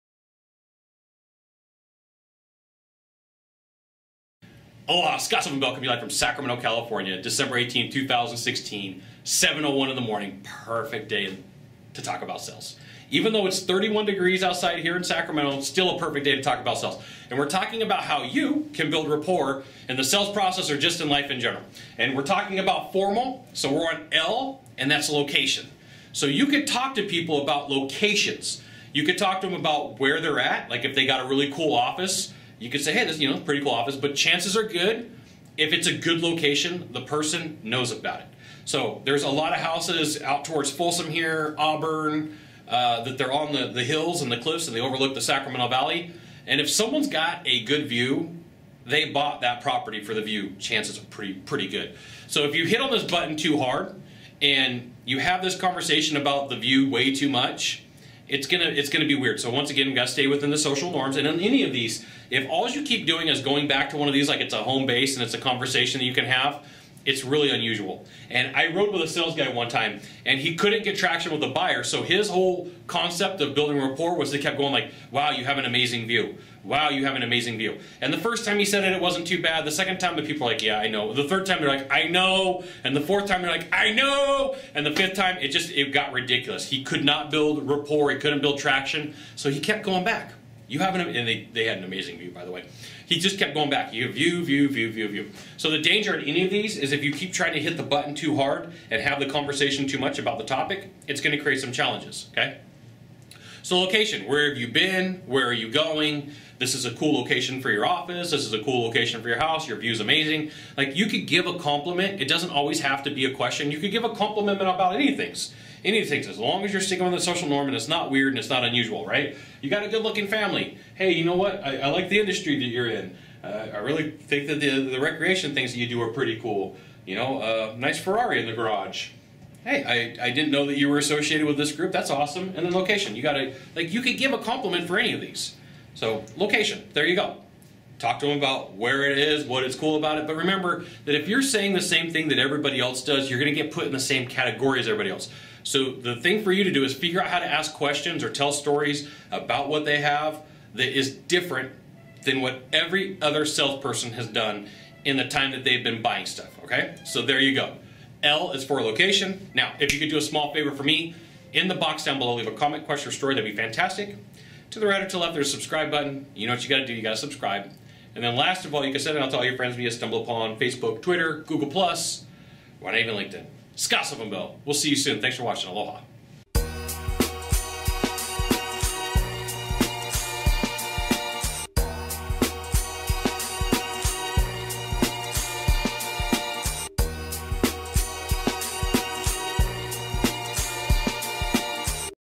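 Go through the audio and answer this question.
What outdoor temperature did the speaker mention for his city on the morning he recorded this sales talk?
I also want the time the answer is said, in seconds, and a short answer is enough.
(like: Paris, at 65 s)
31 degrees, at 13 s.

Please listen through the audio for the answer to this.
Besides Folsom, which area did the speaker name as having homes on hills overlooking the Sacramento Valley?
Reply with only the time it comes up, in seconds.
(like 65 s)
41 s.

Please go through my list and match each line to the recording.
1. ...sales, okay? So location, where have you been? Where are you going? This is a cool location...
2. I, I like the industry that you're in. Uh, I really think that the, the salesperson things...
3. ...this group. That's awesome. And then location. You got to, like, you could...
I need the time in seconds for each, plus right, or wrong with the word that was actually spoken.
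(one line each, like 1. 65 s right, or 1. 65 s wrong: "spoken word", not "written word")
1. 101 s wrong: "challenges", not "sales"
2. 121 s wrong: "recreation", not "salesperson"
3. 131 s right.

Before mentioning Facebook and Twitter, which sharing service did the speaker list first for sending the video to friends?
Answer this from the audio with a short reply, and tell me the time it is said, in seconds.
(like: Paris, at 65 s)
StumbleUpon, at 169 s.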